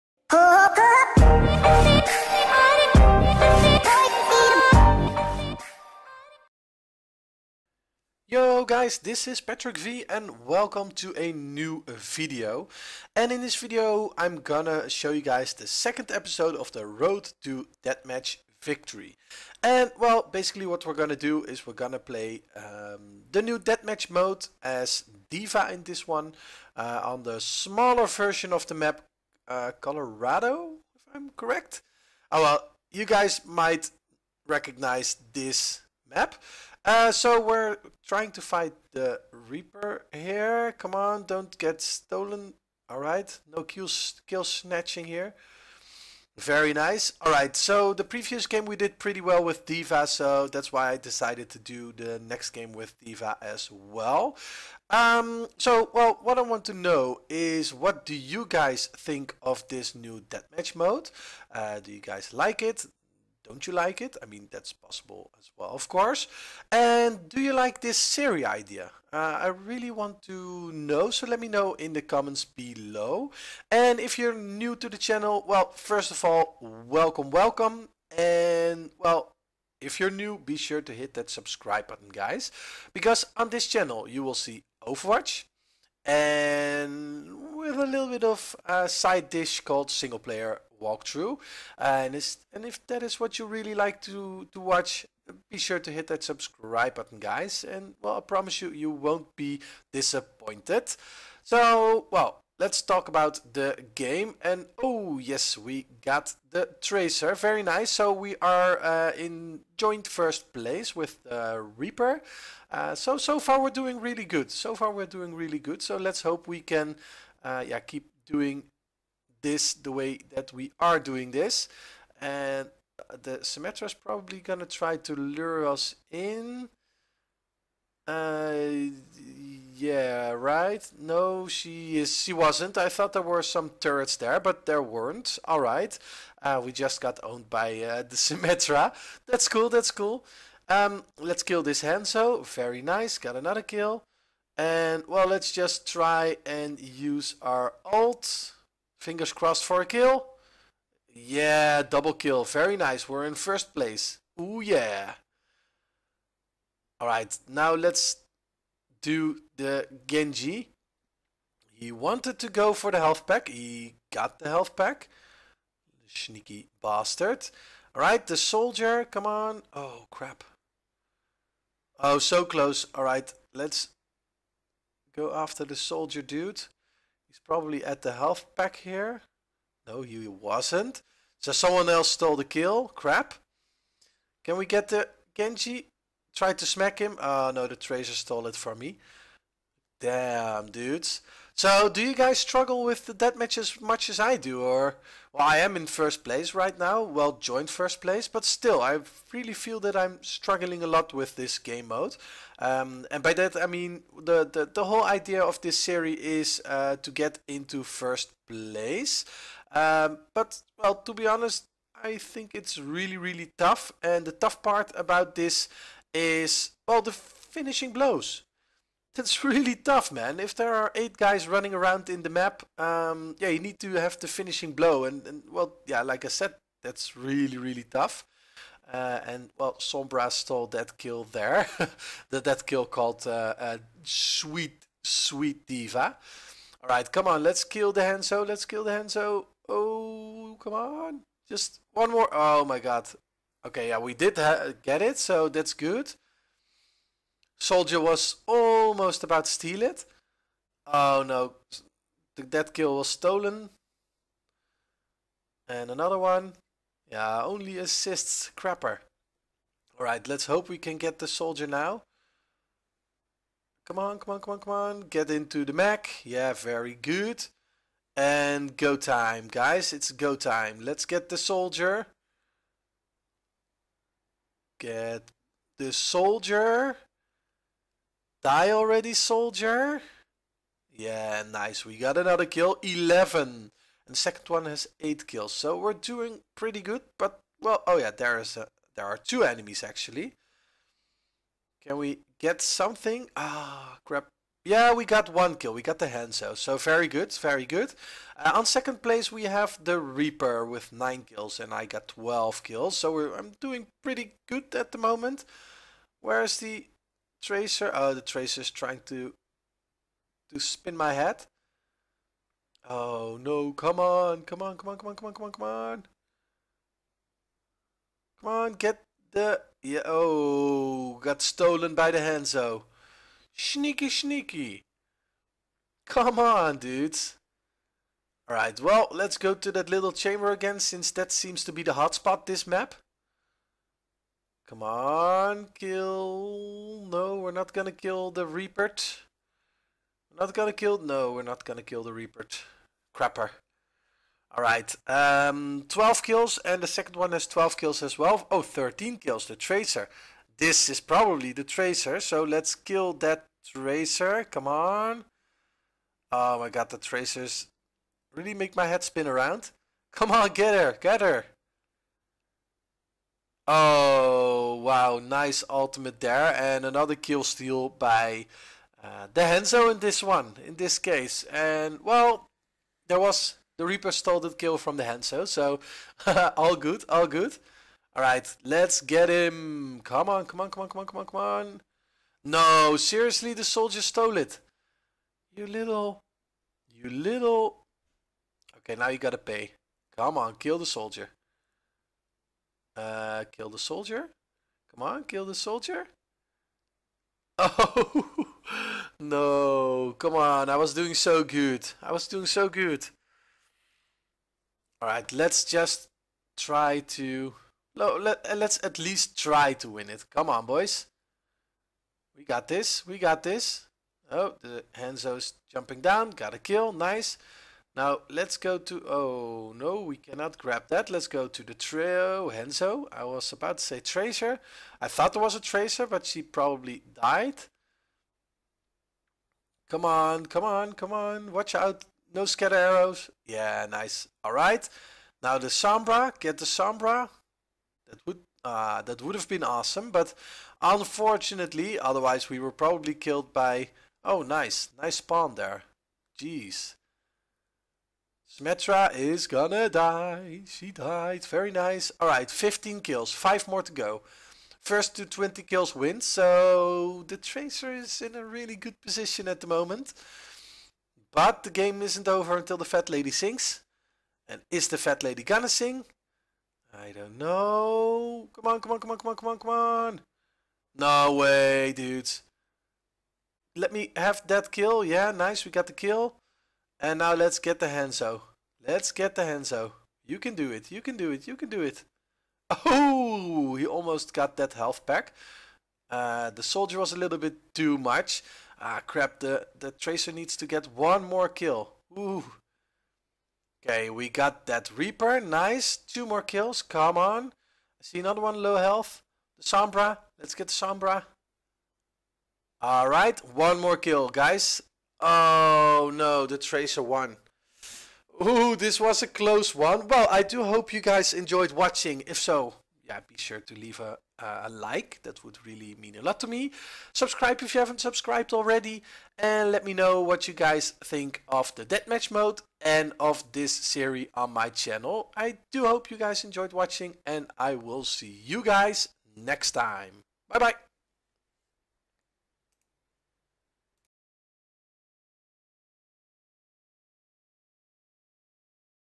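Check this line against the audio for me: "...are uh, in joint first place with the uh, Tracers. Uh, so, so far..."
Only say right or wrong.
wrong.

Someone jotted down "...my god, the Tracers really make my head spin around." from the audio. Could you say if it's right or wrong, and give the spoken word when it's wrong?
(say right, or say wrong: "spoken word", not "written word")
right.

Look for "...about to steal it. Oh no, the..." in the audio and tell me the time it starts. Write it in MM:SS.
04:09.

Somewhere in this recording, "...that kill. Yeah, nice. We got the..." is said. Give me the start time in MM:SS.
07:54.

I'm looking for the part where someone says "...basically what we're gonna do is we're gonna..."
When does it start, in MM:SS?
00:20.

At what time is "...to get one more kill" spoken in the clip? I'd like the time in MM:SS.
08:10.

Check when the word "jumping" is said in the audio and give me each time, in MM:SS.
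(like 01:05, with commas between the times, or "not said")
06:55.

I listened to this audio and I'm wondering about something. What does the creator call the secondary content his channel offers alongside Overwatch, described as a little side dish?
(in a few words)
single player walkthrough.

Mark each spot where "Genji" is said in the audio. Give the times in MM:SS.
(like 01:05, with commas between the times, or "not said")
02:40, 03:05.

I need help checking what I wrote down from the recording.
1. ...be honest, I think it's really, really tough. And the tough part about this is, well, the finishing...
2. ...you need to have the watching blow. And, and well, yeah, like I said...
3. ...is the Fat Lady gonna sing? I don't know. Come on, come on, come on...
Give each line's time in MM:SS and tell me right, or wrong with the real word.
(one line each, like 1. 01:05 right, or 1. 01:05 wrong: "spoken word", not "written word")
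1. 03:31 right
2. 03:43 wrong: "finishing", not "watching"
3. 07:44 right.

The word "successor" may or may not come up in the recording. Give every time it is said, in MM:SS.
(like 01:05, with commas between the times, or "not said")
not said.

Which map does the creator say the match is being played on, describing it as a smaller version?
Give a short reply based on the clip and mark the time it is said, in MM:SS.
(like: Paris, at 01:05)
Colorado, at 00:29.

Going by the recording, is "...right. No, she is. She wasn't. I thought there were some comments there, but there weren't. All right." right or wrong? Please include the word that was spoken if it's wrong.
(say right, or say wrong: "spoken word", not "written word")
wrong: "turrets", not "comments".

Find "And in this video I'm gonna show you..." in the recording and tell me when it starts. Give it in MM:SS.
00:13.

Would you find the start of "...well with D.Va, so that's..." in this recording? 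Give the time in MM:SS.
00:49.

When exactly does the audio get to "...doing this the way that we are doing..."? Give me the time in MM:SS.
01:58.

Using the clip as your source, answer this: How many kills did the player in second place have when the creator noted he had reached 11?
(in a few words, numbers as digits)
8.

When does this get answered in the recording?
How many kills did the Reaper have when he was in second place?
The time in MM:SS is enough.
05:00.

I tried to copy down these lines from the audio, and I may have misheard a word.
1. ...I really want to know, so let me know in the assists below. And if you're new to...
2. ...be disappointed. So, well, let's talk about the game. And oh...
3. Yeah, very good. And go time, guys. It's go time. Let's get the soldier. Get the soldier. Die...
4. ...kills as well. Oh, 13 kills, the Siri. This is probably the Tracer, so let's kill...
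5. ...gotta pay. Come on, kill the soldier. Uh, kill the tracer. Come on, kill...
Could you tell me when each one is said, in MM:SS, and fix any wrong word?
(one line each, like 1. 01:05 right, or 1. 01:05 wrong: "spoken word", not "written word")
1. 01:09 wrong: "comments", not "assists"
2. 01:39 right
3. 04:26 right
4. 05:47 wrong: "Tracer", not "Siri"
5. 06:29 wrong: "soldier", not "tracer".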